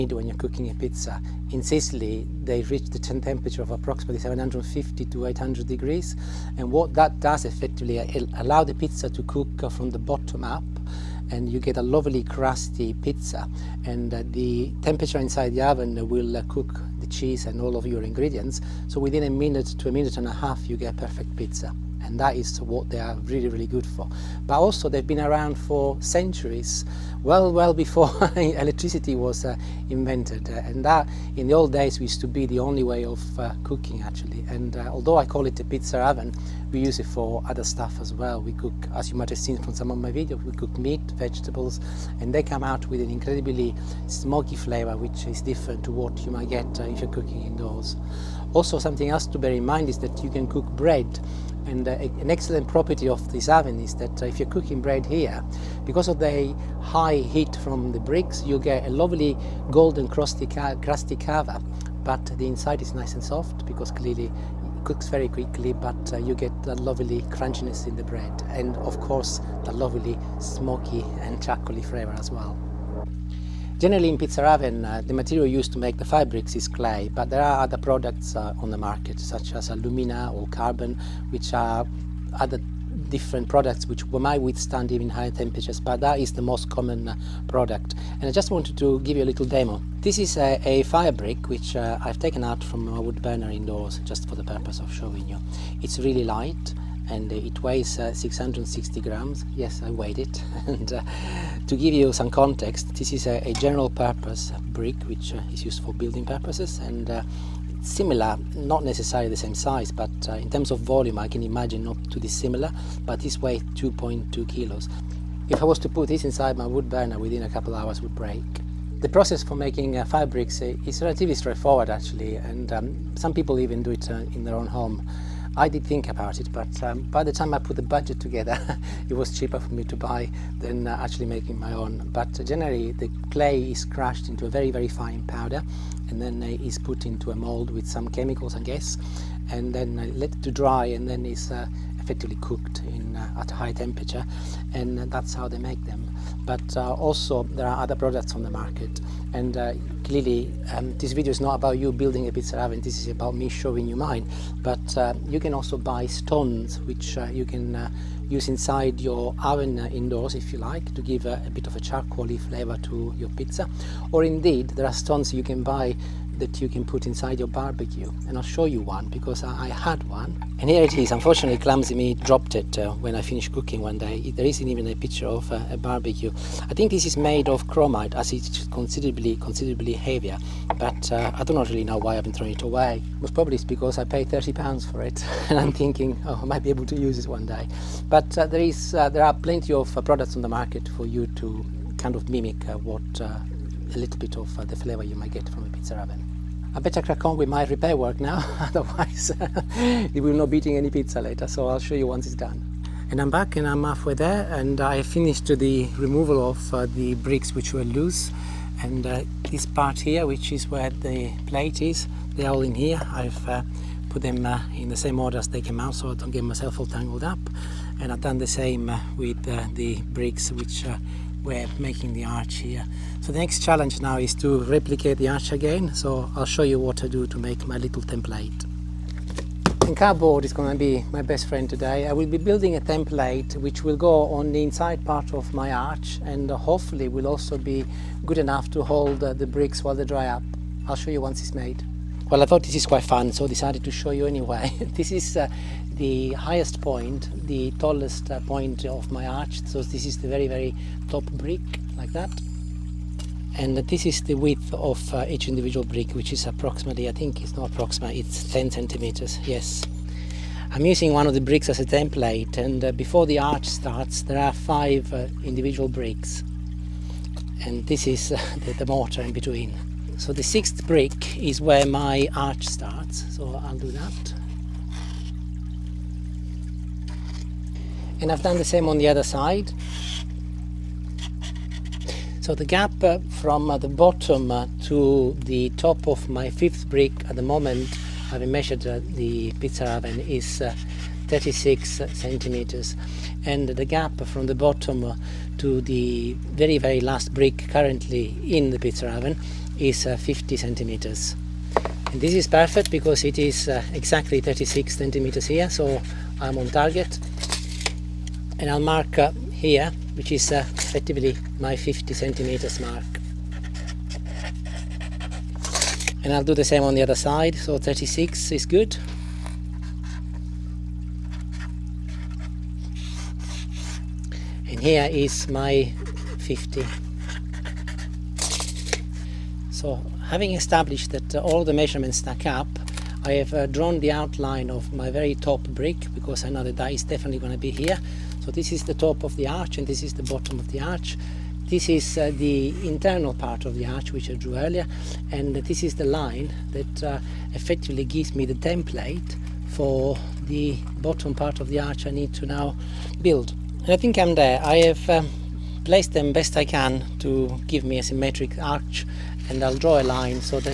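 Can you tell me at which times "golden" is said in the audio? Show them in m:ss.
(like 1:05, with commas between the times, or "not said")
0:59.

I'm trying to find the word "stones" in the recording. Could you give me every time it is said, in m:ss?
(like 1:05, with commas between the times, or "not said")
2:36, 2:44.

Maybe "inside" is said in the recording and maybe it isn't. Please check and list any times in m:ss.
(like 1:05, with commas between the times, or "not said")
0:15, 1:02, 1:56, 2:38, 2:47, 3:54.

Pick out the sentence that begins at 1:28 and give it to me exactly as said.
And I just wanted to give you a little demo.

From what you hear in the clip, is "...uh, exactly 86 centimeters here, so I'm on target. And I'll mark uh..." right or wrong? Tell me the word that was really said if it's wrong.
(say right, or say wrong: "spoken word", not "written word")
wrong: "36", not "86".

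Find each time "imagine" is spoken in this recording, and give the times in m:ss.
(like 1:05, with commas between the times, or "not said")
1:51.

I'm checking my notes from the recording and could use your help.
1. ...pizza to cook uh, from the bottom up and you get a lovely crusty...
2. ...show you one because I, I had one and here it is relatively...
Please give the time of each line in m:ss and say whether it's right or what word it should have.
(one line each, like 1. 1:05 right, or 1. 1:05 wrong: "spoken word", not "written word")
1. 0:08 right
2. 2:48 wrong: "unfortunately", not "relatively".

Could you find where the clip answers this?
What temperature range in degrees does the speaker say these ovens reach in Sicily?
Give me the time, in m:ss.
0:04.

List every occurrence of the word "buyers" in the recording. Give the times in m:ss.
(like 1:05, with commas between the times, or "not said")
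not said.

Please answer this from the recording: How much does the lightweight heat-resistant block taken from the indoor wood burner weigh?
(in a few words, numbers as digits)
660 grams.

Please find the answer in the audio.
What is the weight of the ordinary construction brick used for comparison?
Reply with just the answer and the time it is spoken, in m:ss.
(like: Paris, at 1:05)
2.2 kilos, at 1:53.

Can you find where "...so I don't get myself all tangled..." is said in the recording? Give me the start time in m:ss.
3:35.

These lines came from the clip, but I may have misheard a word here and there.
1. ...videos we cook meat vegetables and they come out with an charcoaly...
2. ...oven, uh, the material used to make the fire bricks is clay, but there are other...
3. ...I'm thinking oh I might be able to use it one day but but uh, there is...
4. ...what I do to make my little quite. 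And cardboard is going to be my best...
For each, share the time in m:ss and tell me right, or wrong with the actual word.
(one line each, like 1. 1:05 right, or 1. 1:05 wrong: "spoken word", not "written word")
1. 0:40 wrong: "incredibly", not "charcoaly"
2. 1:14 right
3. 3:05 right
4. 3:46 wrong: "template", not "quite".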